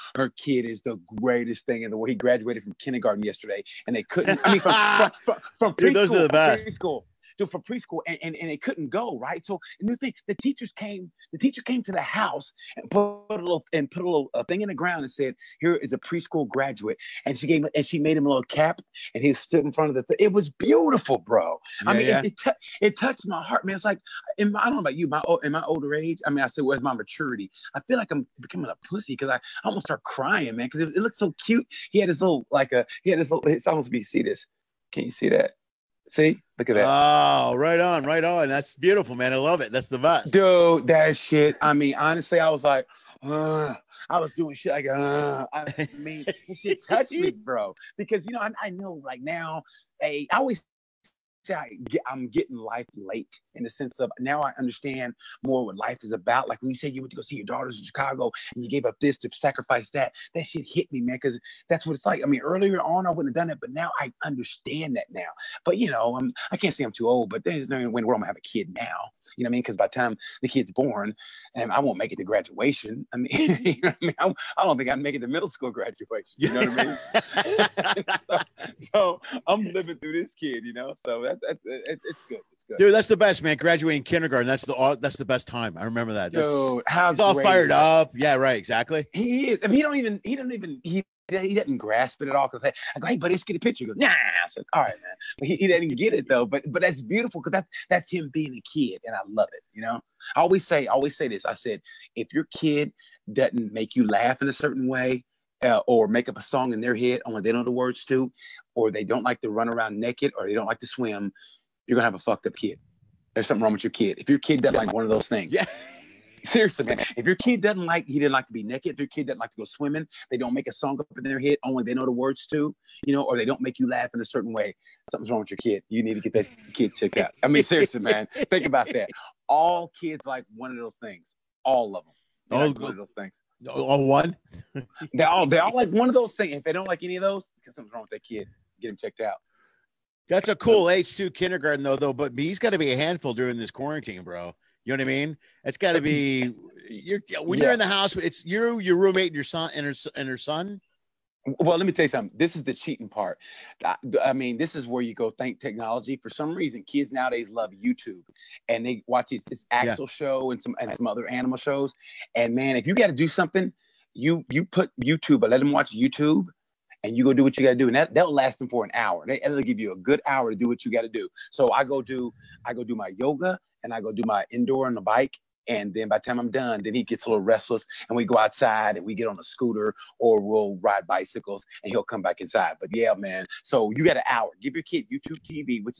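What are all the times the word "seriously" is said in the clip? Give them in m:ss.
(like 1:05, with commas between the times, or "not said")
1:56, 2:07.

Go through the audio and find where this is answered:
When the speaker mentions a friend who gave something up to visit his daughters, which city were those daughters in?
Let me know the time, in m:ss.
0:57.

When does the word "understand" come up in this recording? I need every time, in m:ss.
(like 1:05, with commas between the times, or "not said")
0:54, 1:04.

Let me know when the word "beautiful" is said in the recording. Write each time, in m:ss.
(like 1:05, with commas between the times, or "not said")
0:20, 0:38, 1:37.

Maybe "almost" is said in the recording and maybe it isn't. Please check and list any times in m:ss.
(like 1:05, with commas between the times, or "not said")
0:29, 0:33.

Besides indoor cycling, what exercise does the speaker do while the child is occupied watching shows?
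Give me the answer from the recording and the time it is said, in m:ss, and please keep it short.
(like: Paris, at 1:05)
Yoga, at 2:53.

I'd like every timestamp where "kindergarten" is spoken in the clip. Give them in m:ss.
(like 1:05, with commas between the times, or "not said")
0:02, 1:24, 2:21.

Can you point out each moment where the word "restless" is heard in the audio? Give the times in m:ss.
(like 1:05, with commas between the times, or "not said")
2:57.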